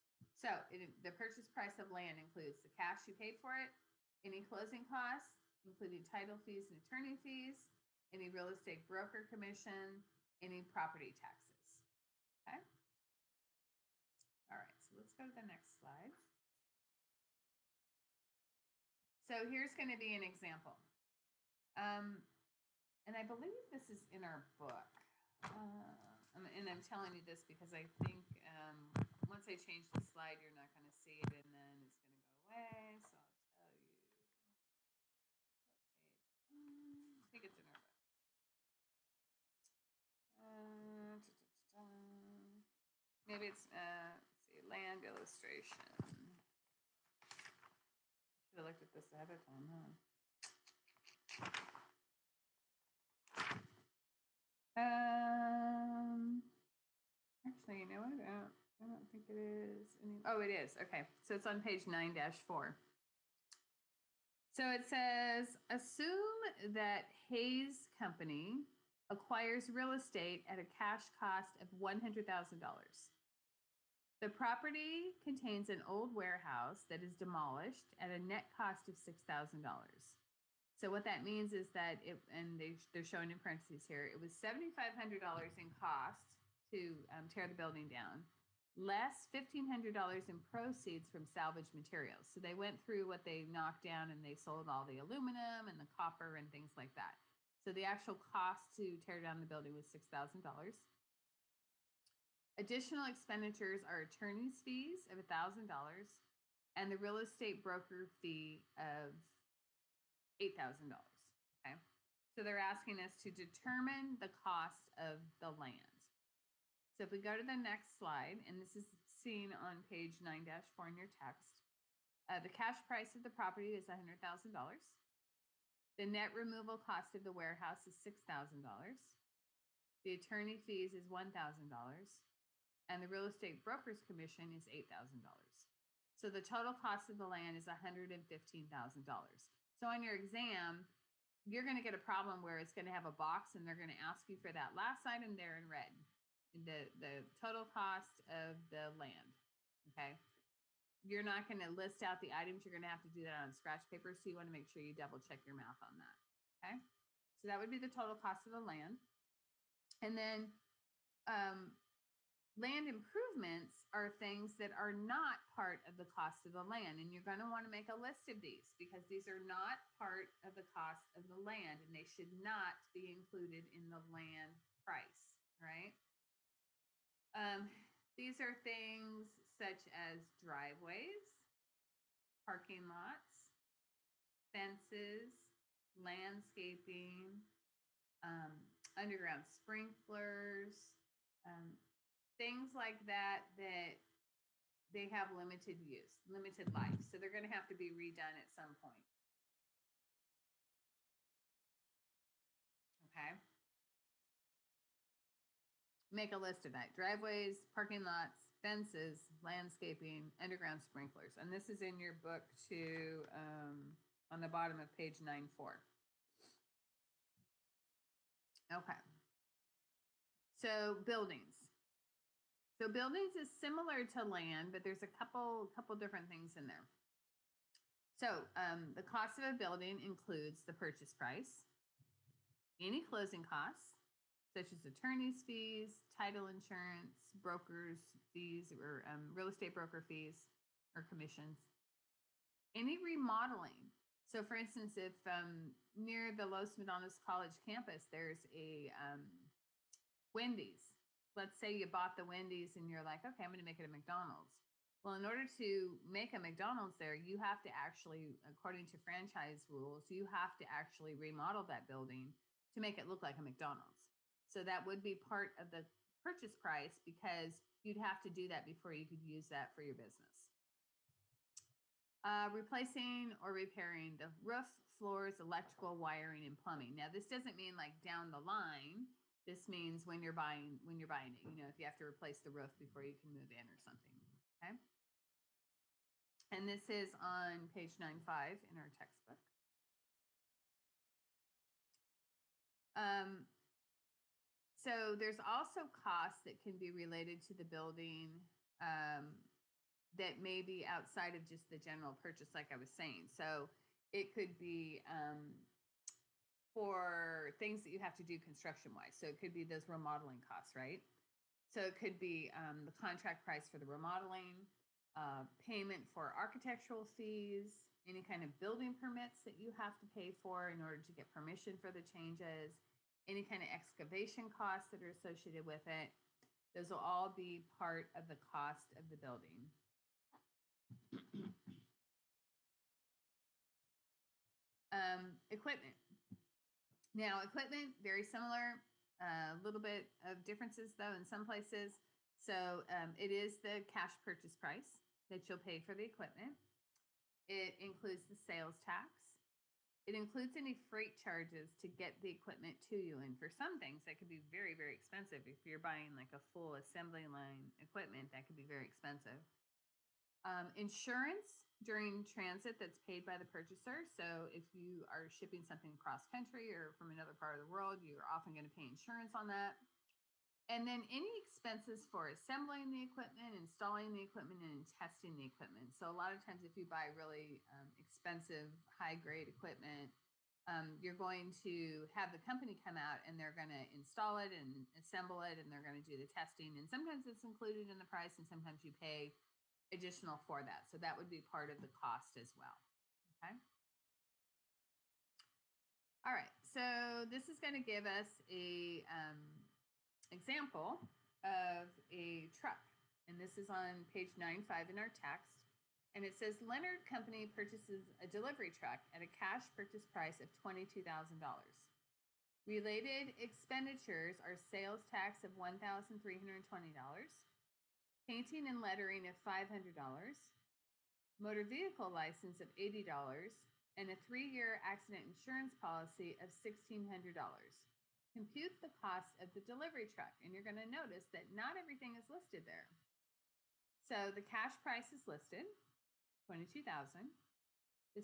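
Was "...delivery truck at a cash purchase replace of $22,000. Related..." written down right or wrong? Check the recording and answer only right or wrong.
wrong.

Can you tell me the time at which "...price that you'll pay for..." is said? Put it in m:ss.
5:44.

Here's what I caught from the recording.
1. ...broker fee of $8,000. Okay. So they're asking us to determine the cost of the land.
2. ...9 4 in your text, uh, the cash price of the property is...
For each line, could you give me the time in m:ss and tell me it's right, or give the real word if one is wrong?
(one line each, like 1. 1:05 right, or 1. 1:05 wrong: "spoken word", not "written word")
1. 1:47 right
2. 2:00 right.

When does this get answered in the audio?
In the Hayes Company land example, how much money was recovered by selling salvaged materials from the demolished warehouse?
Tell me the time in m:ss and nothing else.
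1:29.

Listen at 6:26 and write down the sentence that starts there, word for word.
And sometimes it's included in the price, and sometimes you pay additional for that.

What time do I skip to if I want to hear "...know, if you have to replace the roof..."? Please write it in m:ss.
4:41.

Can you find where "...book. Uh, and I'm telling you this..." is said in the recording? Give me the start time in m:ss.
0:24.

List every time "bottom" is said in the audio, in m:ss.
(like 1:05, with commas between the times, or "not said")
3:34.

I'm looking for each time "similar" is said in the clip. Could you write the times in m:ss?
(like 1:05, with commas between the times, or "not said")
3:43, 5:38.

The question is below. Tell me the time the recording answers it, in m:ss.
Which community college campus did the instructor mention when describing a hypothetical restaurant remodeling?
4:06.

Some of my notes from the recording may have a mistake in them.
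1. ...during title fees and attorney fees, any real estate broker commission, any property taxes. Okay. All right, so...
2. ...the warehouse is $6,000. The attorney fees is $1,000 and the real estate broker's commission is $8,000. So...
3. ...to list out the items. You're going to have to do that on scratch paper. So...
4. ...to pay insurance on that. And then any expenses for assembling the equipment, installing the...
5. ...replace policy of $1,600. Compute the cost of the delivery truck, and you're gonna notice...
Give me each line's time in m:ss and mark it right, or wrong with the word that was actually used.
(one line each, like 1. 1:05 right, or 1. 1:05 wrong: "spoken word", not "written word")
1. 0:05 wrong: "including", not "during"
2. 2:07 right
3. 2:31 right
4. 6:08 right
5. 7:05 wrong: "insurance", not "replace".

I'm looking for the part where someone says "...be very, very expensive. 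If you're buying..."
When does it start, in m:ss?
5:54.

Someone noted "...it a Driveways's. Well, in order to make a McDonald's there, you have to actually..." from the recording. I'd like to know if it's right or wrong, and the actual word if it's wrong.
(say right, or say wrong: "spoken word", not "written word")
wrong: "McDonald", not "Driveways".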